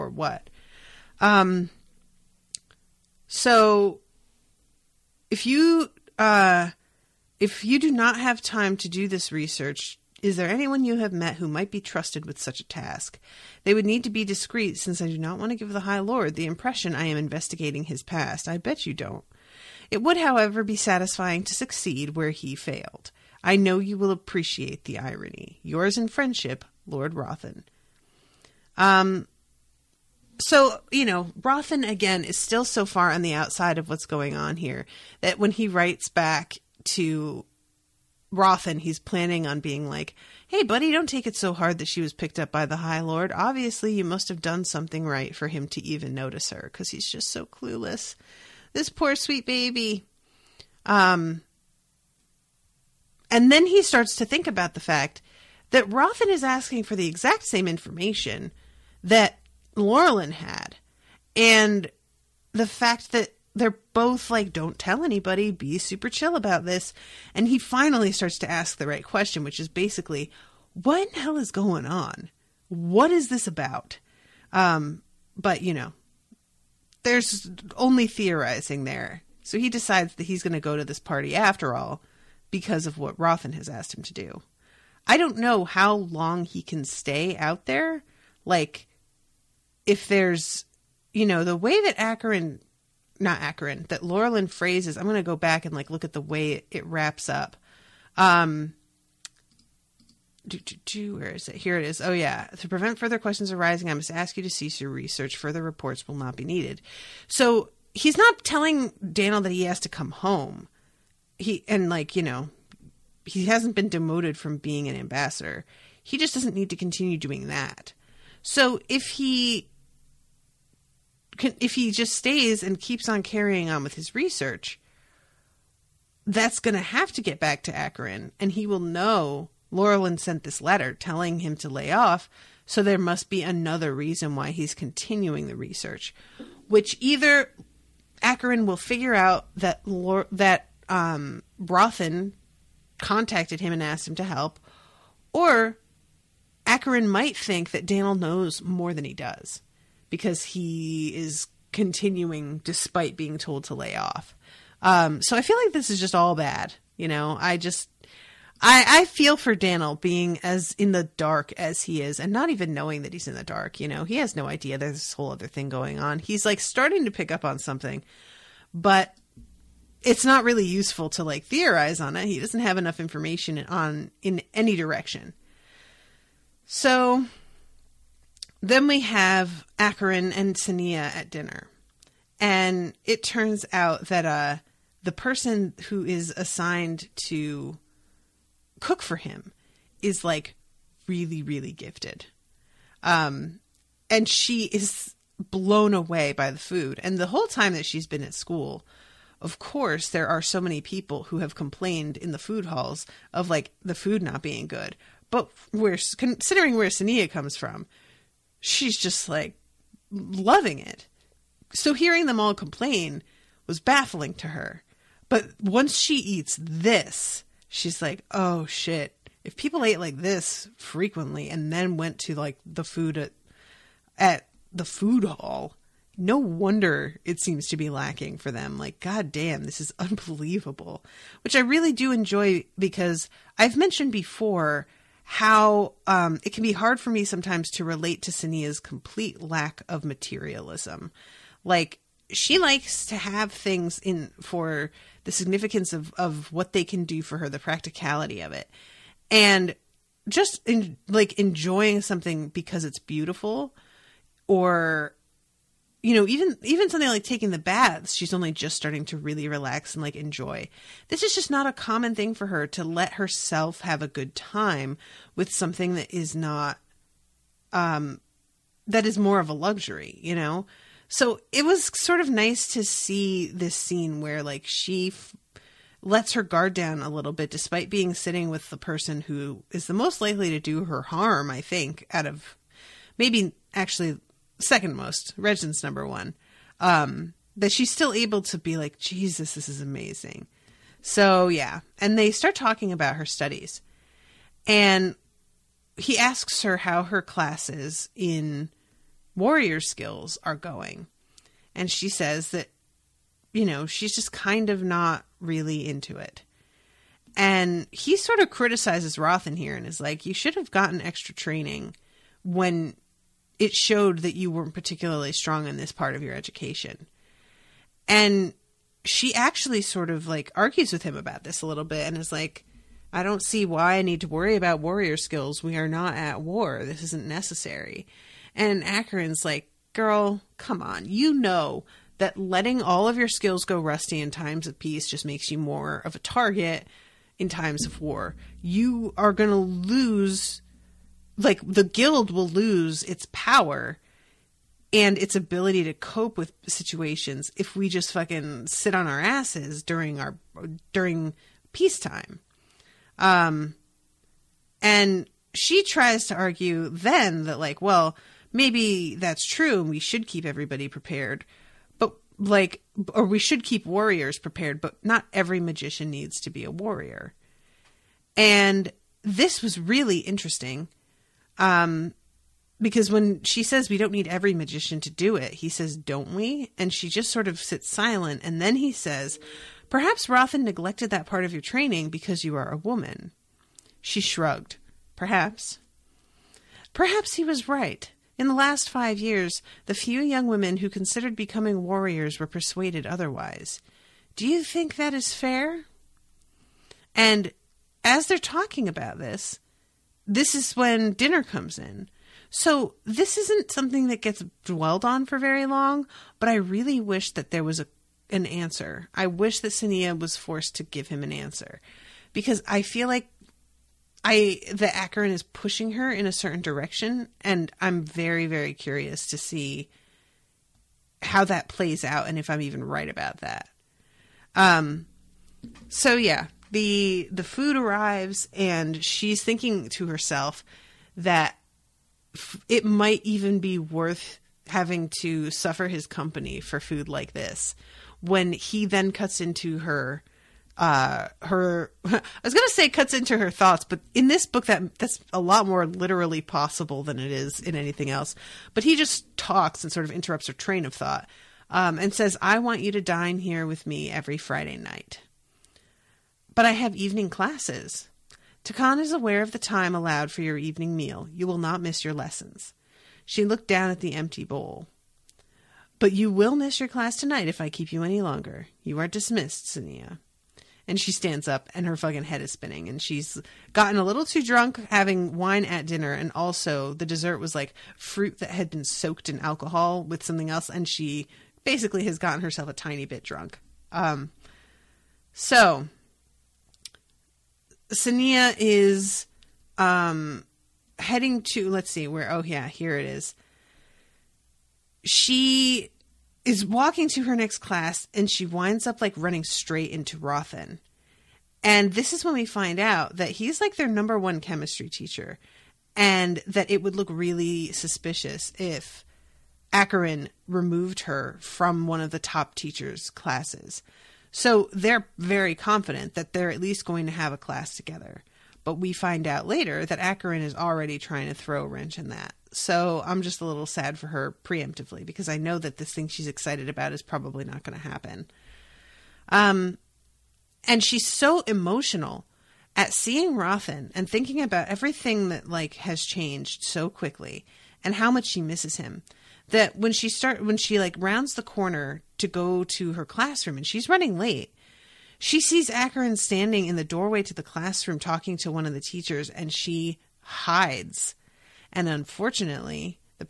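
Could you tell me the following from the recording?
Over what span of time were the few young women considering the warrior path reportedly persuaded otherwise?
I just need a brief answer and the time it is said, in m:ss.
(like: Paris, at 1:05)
Last five years, at 6:28.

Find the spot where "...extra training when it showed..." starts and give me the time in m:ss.
5:11.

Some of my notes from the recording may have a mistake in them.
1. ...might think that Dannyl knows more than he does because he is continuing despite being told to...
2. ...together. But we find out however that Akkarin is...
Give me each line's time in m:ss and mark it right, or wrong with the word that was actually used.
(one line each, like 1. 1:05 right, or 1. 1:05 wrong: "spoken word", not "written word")
1. 2:27 right
2. 8:37 wrong: "later", not "however".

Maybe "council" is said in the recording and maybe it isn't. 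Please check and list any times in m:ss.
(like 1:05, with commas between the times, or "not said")
not said.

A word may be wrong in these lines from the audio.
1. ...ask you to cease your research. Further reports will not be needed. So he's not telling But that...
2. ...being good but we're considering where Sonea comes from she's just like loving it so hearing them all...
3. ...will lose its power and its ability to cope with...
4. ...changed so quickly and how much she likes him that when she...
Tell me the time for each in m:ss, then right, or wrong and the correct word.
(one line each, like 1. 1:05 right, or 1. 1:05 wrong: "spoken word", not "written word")
1. 1:44 wrong: "Dannyl", not "But"
2. 3:24 right
3. 5:42 right
4. 8:56 wrong: "misses", not "likes".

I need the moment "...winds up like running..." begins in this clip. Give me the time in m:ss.
8:18.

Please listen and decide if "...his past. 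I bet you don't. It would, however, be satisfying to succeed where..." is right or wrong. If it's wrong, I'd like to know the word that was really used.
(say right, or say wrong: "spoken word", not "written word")
right.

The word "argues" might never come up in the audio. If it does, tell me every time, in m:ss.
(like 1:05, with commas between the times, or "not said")
5:20, 5:56.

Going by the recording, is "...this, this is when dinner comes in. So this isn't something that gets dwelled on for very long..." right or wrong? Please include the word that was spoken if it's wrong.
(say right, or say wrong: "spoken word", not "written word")
right.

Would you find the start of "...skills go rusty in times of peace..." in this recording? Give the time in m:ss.
5:33.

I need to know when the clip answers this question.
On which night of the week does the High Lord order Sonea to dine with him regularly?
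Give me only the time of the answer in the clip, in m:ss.
7:34.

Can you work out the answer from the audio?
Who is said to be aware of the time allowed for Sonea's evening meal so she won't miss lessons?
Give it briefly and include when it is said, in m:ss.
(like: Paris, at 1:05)
Takan, at 7:38.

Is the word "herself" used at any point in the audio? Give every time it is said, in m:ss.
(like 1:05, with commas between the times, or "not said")
4:23, 7:10, 8:02.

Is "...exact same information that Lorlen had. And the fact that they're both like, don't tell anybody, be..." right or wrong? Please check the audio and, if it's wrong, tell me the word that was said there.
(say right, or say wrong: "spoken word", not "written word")
right.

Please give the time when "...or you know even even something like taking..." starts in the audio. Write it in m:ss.
4:14.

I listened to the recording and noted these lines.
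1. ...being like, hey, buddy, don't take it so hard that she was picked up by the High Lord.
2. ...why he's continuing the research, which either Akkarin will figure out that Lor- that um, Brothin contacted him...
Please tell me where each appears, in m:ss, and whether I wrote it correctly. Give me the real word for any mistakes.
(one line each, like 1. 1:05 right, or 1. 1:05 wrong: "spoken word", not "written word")
1. 0:39 right
2. 2:14 right.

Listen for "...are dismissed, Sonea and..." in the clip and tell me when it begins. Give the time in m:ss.
7:48.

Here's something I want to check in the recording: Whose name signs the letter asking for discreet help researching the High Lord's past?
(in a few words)
Lord Rothen.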